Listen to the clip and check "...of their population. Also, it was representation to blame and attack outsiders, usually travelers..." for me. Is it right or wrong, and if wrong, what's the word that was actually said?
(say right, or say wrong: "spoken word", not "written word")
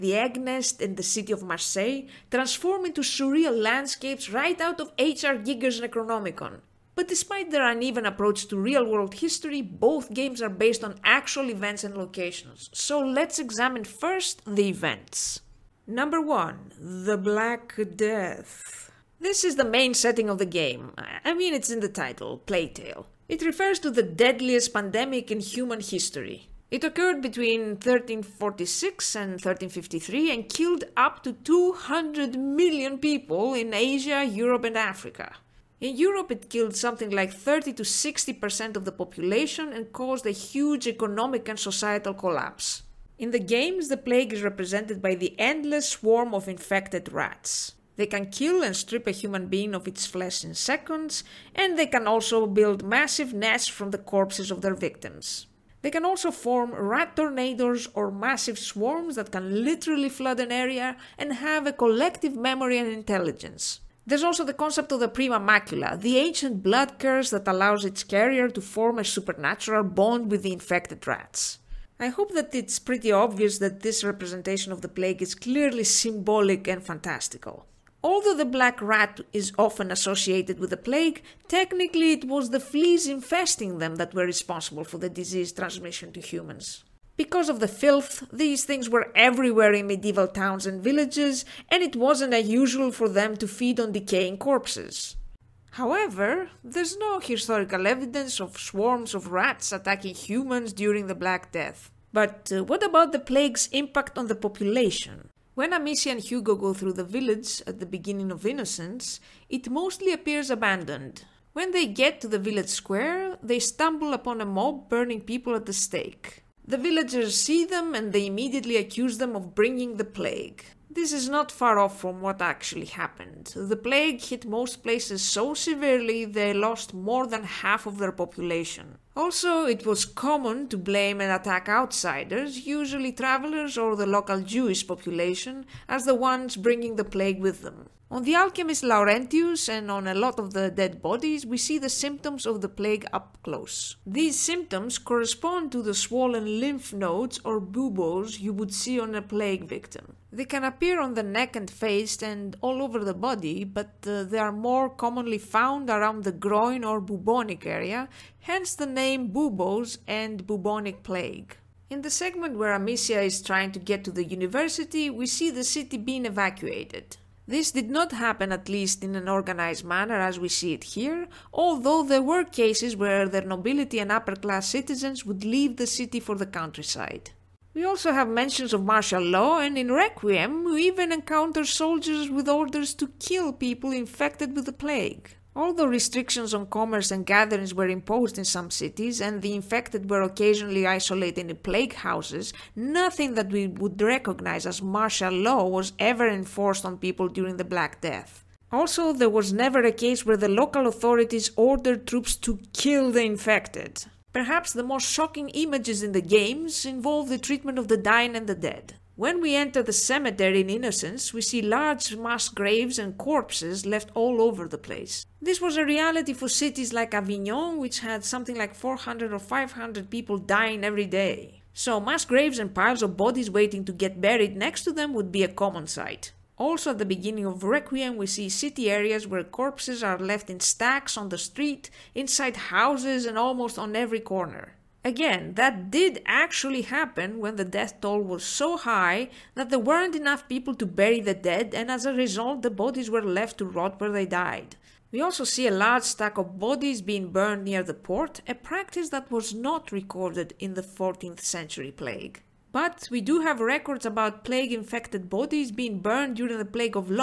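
wrong: "common", not "representation".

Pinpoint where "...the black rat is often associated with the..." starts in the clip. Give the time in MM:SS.
01:18.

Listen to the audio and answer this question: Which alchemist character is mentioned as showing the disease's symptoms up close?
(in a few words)
Laurentius.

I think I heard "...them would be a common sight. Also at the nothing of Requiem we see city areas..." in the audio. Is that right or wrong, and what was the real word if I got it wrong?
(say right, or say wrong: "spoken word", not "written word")
wrong: "beginning", not "nothing".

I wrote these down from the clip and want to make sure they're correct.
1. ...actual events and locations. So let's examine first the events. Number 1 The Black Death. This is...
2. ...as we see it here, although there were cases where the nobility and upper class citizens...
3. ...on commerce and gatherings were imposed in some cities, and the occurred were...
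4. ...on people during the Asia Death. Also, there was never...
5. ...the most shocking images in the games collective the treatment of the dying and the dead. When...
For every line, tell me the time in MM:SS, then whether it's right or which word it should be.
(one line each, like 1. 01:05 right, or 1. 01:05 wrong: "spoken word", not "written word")
1. 00:11 right
2. 02:50 right
3. 03:06 wrong: "infected", not "occurred"
4. 03:16 wrong: "Black", not "Asia"
5. 03:24 wrong: "involve", not "collective".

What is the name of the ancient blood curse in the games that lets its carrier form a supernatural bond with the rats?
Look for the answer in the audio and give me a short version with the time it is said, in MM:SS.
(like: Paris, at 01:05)
prima macula, at 01:05.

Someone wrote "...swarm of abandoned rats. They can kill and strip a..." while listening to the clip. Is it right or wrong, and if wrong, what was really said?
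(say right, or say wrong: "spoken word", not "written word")
wrong: "infected", not "abandoned".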